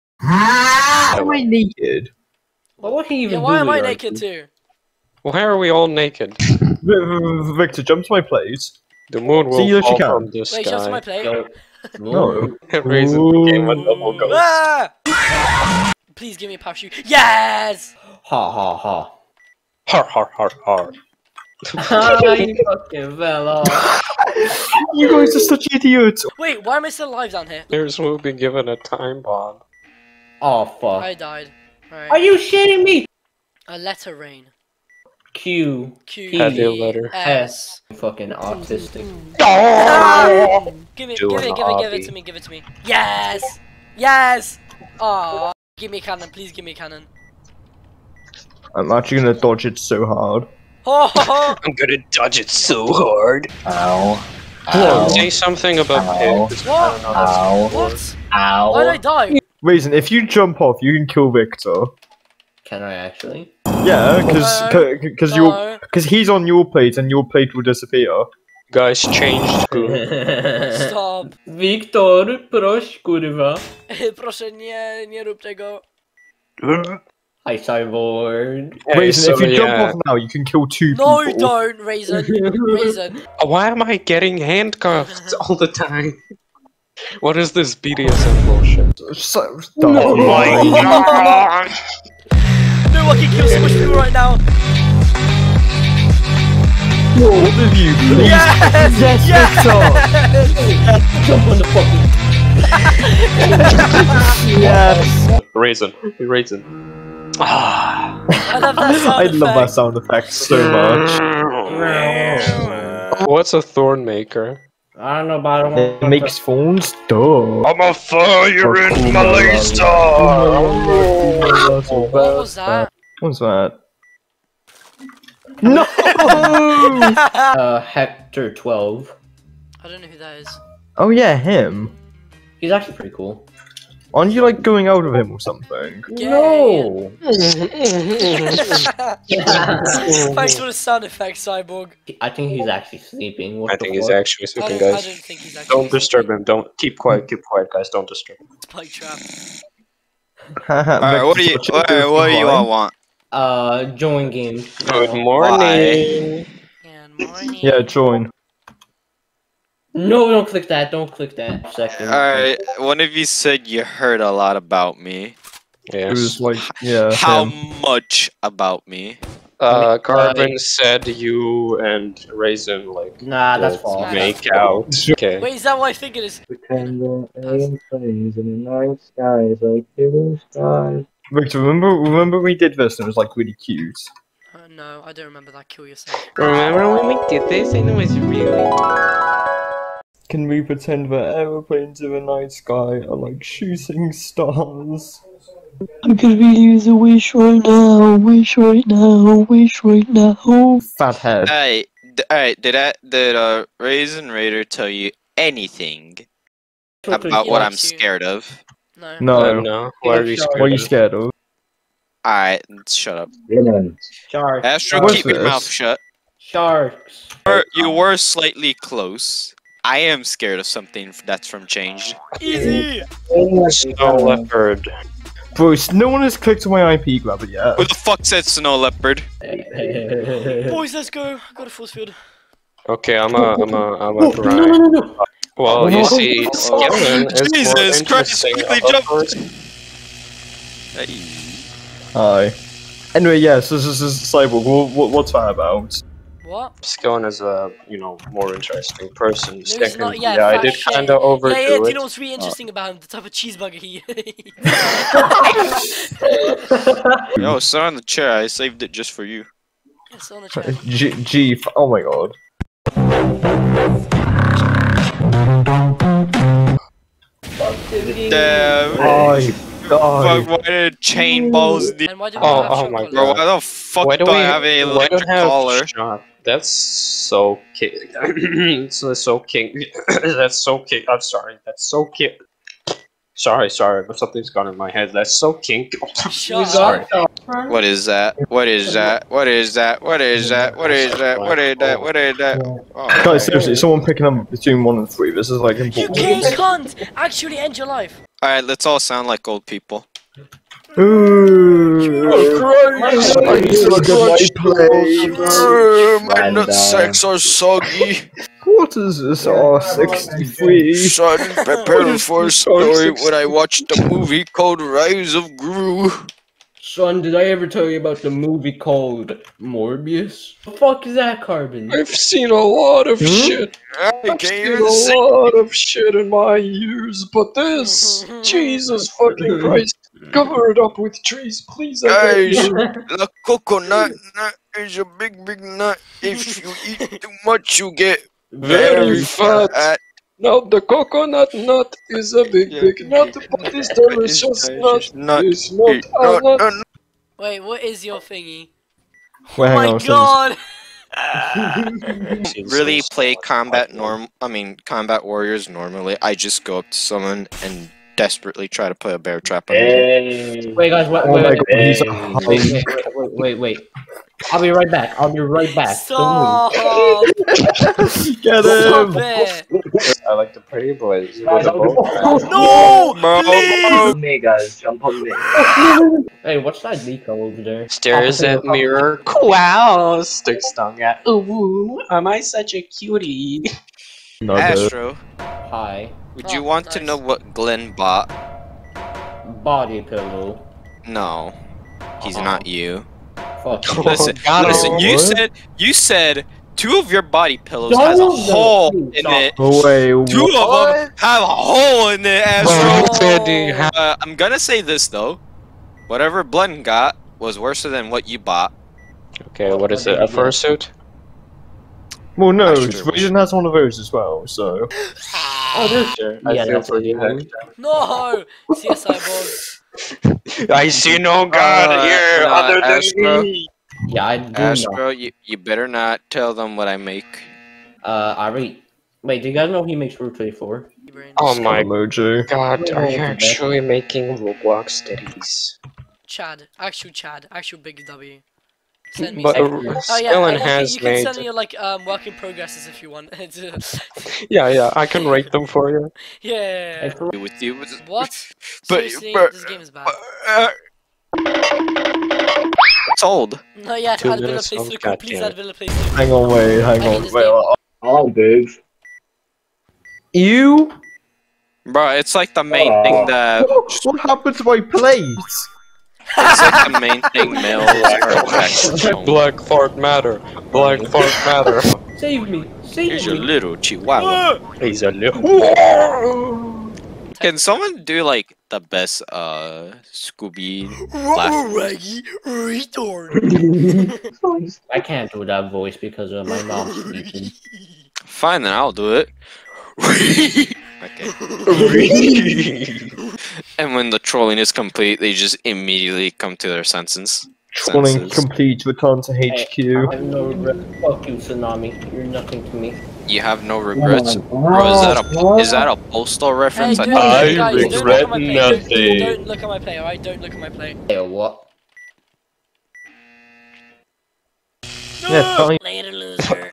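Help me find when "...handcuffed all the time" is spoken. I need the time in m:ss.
1:24.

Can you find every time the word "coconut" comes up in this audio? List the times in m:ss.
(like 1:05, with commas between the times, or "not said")
5:33, 5:40.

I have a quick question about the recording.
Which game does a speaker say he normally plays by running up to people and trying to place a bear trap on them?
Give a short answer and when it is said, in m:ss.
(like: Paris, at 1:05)
Combat Warriors, at 5:54.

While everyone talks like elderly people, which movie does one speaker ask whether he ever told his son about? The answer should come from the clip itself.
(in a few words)
Morbius.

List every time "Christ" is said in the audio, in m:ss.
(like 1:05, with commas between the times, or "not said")
3:58, 5:29.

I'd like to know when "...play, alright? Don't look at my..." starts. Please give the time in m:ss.
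8:29.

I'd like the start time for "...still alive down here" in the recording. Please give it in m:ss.
0:26.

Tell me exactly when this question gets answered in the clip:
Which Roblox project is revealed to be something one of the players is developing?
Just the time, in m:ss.
7:10.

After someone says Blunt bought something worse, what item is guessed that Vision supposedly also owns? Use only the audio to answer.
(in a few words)
A fursuit.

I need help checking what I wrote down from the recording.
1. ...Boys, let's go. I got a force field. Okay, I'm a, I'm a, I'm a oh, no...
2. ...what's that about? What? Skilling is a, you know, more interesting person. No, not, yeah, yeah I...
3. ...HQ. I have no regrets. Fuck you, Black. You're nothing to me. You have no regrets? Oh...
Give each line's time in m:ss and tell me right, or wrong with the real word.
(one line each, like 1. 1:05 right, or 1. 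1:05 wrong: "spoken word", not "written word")
1. 3:49 right
2. 4:05 right
3. 8:19 wrong: "Tsunami", not "Black".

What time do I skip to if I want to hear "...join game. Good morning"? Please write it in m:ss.
2:33.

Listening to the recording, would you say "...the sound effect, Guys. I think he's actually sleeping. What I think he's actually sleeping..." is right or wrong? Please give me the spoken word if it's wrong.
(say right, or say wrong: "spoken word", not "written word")
wrong: "Cyborg", not "Guys".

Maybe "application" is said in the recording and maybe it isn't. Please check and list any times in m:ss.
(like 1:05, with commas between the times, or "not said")
not said.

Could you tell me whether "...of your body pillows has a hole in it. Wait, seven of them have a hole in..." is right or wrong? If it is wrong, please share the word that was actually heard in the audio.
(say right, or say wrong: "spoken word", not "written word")
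wrong: "two", not "seven".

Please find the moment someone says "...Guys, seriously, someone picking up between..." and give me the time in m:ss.
4:53.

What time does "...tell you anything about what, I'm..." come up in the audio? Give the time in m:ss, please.
3:24.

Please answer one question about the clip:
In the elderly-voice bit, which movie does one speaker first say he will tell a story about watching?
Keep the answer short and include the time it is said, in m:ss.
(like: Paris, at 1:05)
Rise of Gru, at 5:14.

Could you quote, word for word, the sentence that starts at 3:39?
I am scared of something that's from Changed.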